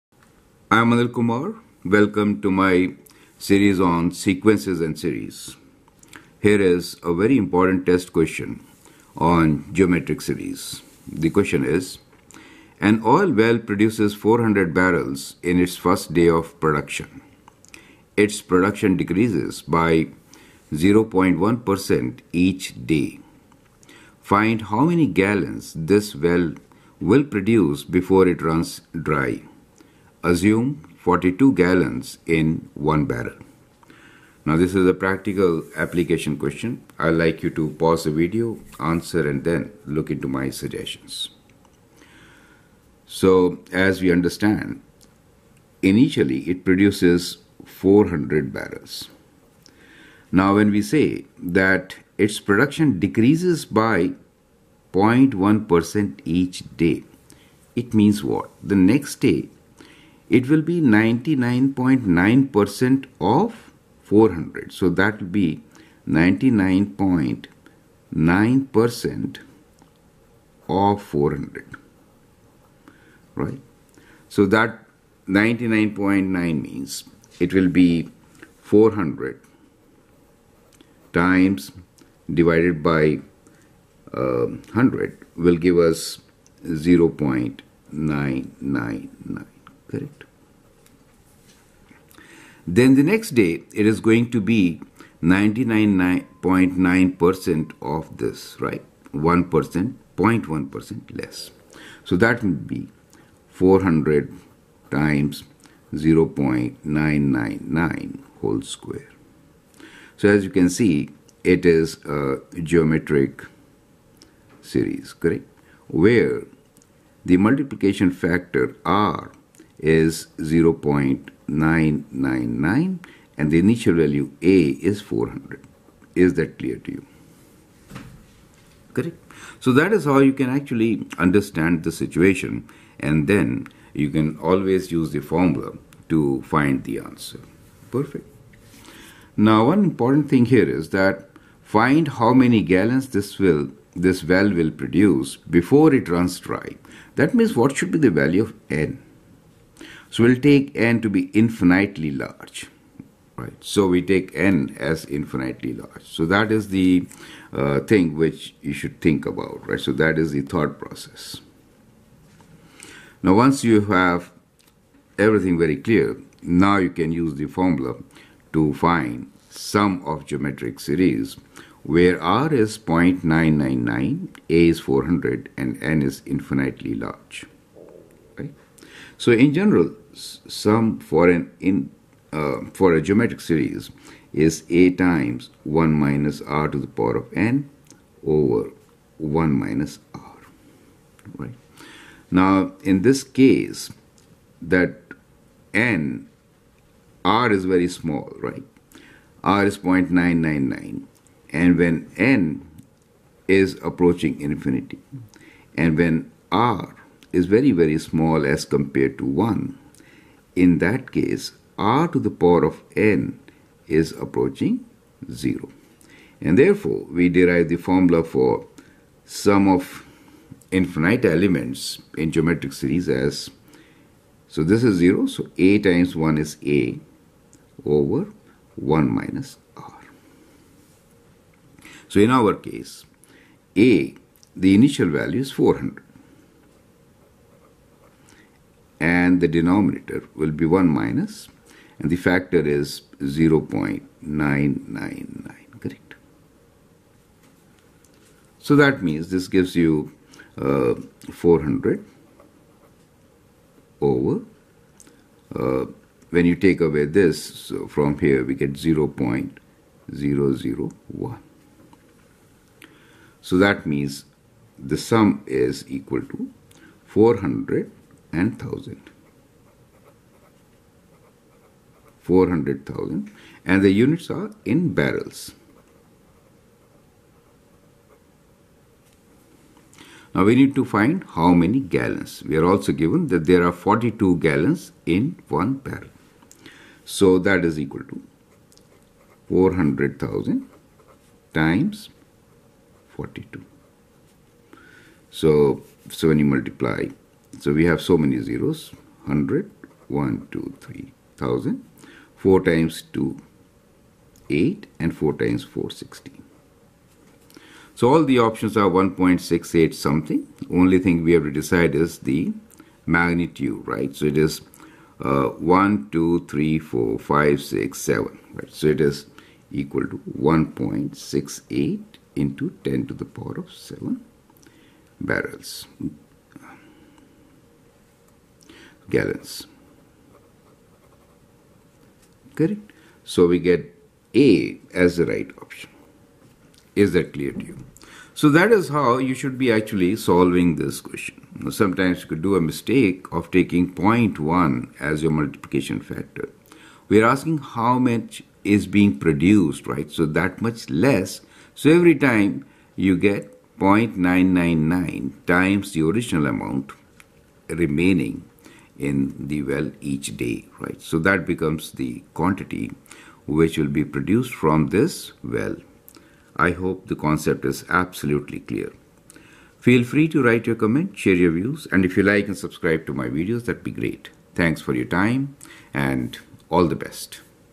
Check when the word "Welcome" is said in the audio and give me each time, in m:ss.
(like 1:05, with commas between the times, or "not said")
0:01.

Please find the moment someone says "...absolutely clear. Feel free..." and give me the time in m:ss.
6:07.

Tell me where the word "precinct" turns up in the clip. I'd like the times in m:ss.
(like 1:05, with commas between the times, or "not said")
not said.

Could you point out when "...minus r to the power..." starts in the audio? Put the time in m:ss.
3:05.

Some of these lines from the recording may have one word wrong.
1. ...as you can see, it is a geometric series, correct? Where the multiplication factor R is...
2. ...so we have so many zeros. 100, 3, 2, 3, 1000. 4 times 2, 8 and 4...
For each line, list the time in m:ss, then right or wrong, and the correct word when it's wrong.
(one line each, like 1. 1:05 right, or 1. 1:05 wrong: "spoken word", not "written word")
1. 1:50 right
2. 4:57 wrong: "1", not "3".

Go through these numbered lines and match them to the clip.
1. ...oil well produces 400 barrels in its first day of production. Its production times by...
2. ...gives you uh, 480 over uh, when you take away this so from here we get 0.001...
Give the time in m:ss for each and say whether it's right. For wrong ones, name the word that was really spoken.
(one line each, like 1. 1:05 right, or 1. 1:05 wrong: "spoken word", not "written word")
1. 0:13 wrong: "decreases", not "times"
2. 4:09 wrong: "400", not "480".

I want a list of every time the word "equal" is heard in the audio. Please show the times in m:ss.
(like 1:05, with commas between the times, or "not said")
4:25, 4:47, 5:19.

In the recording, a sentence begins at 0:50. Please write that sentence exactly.
Now when we say that its production decreases by 0.1% each day, it means what?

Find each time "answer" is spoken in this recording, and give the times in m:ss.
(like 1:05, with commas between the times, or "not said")
0:38, 2:16.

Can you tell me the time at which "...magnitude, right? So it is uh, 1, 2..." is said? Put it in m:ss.
5:13.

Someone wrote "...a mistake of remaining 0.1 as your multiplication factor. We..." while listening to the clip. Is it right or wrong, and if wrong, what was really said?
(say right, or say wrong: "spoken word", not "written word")
wrong: "taking", not "remaining".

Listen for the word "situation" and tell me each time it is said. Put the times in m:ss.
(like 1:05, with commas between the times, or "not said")
2:11.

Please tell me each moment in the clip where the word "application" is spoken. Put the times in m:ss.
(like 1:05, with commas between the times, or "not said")
0:35.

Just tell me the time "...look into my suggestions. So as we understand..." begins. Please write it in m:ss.
0:39.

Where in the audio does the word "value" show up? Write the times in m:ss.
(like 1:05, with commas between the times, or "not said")
2:03, 2:28, 3:55.